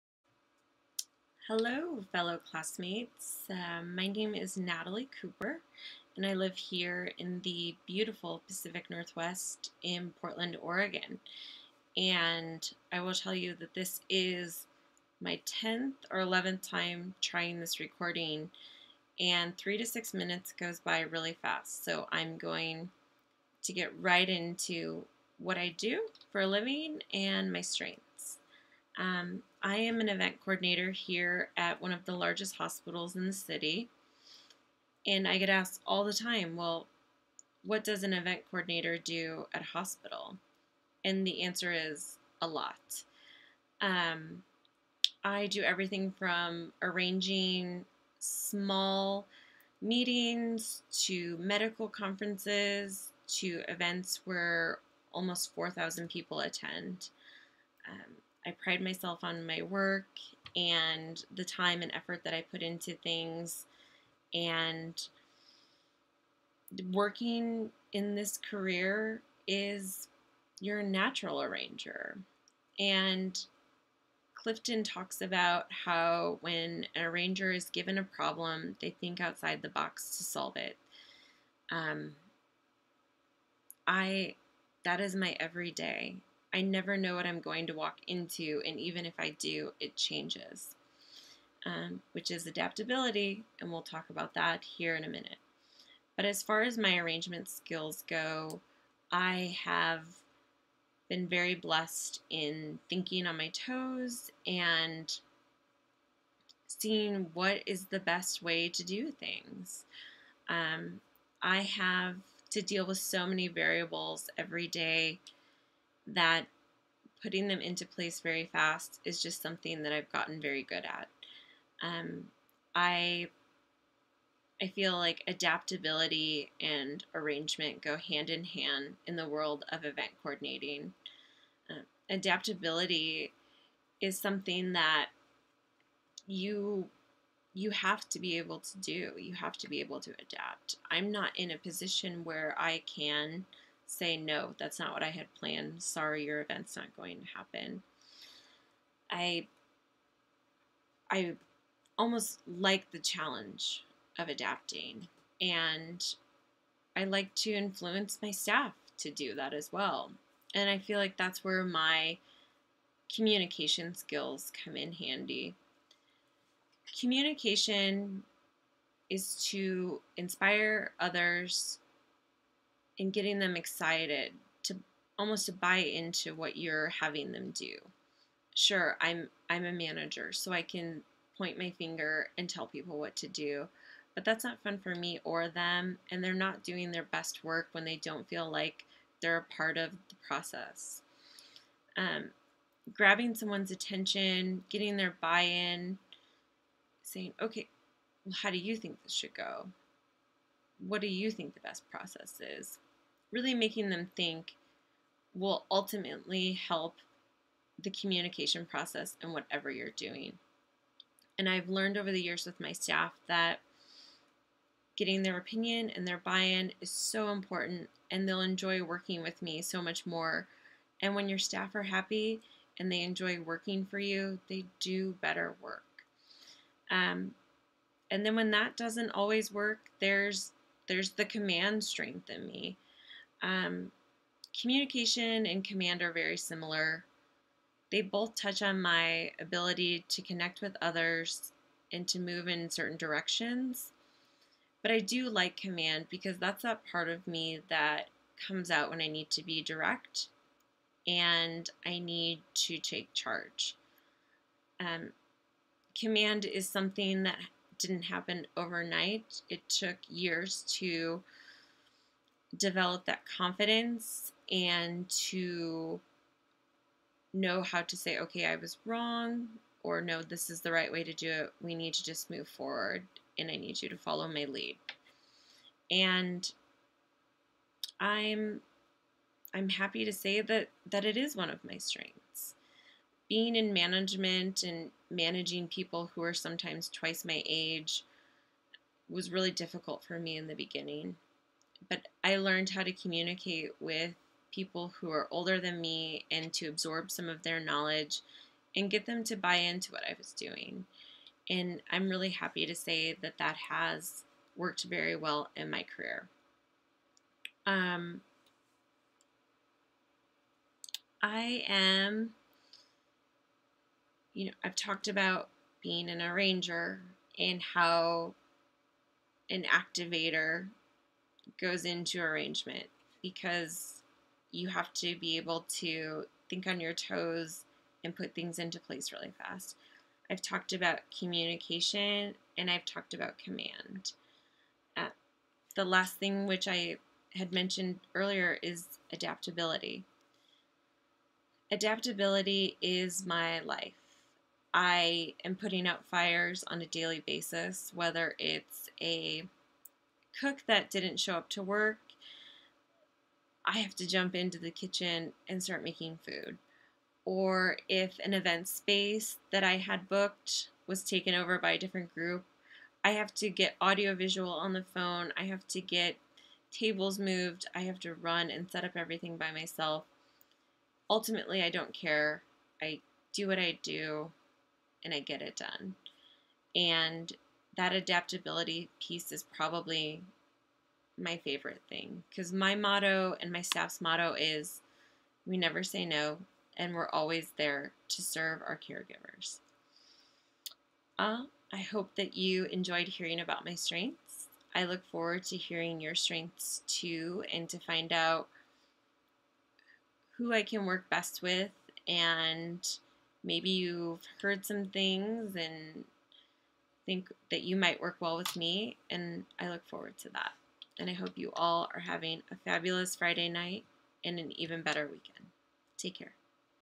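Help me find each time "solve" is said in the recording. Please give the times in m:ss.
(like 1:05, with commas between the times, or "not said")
1:20.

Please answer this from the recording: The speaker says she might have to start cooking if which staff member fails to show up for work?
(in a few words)
A cook.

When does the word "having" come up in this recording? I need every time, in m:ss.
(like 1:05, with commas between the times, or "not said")
2:56, 6:52.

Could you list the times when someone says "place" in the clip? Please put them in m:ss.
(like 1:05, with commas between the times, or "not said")
1:57, 5:28.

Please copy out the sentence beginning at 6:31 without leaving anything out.
Uh, I hope that you enjoyed hearing about my strengths.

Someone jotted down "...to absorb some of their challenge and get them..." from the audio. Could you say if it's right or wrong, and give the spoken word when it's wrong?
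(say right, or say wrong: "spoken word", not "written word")
wrong: "knowledge", not "challenge".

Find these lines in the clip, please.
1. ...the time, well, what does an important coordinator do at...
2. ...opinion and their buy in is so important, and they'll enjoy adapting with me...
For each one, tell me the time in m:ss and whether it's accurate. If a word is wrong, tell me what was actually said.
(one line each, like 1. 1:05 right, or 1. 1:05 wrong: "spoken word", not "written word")
1. 0:36 wrong: "event", not "important"
2. 3:35 wrong: "working", not "adapting".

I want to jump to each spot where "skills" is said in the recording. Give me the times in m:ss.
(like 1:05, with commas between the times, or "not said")
1:37, 2:43.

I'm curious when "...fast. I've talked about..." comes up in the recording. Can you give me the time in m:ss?
5:29.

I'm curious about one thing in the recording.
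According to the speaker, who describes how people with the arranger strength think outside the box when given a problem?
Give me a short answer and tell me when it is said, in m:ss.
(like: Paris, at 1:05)
Clifton, at 1:14.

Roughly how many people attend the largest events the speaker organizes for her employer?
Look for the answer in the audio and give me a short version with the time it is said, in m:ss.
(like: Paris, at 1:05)
4,000, at 0:55.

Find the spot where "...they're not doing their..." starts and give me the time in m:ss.
3:06.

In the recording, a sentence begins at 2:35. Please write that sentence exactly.
And I like to influence my staff to do that as well.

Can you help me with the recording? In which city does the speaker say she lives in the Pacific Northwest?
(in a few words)
Portland, Oregon.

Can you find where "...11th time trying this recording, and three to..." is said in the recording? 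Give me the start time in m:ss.
0:16.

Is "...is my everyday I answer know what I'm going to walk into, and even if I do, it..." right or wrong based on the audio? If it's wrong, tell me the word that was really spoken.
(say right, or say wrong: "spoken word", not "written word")
wrong: "never", not "answer".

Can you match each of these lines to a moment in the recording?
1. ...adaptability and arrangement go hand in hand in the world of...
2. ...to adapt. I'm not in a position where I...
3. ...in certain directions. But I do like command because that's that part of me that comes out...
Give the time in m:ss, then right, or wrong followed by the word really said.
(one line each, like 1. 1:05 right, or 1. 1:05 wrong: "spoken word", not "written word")
1. 2:05 right
2. 2:20 right
3. 4:02 right.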